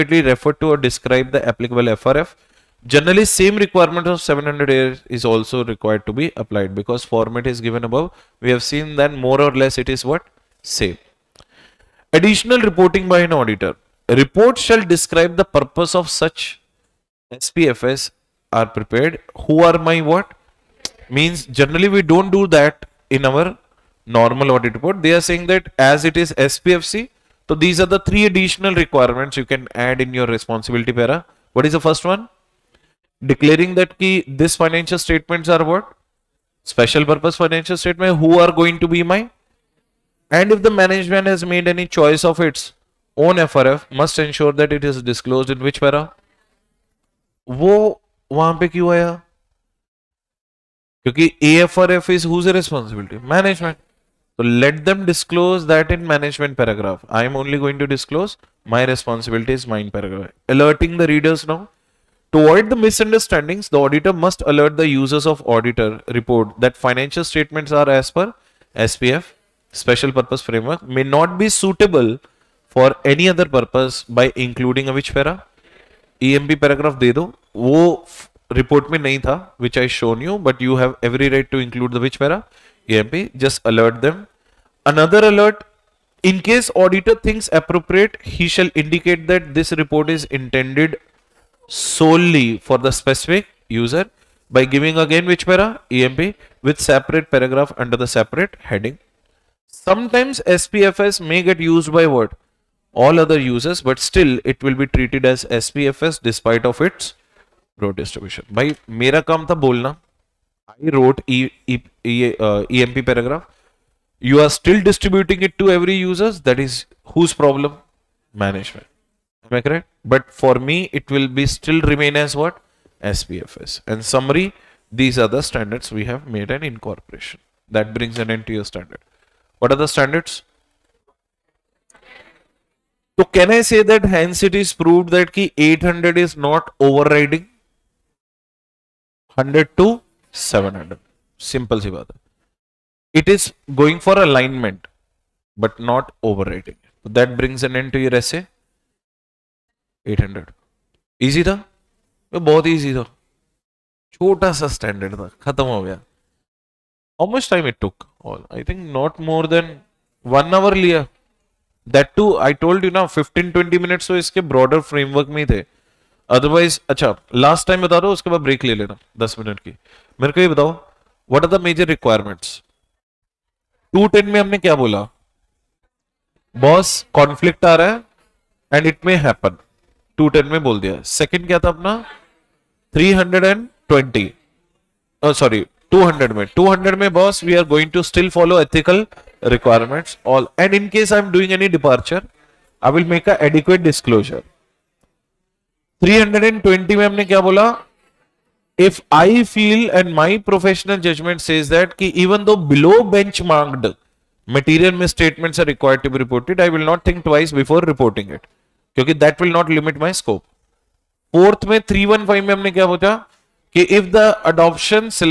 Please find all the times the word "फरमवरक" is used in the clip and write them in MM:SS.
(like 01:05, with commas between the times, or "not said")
02:44.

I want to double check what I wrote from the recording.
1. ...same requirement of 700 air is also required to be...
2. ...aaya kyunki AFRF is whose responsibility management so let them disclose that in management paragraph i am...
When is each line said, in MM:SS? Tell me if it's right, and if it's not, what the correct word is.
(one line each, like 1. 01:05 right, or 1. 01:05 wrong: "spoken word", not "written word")
1. 00:03 right
2. 00:48 right.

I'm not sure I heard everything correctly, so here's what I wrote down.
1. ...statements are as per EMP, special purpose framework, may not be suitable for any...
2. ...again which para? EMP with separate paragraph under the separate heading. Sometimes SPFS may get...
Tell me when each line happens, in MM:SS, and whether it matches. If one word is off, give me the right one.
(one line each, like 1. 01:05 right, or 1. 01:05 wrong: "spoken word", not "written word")
1. 01:07 wrong: "SPF", not "EMP"
2. 01:34 right.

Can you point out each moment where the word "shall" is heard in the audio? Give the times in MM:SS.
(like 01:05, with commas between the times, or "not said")
00:14, 01:28.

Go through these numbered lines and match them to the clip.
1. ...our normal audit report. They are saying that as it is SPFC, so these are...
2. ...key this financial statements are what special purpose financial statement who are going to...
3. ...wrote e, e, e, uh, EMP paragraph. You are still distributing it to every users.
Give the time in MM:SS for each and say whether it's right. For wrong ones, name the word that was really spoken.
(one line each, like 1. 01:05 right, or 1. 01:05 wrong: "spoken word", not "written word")
1. 00:23 right
2. 00:33 right
3. 01:50 right.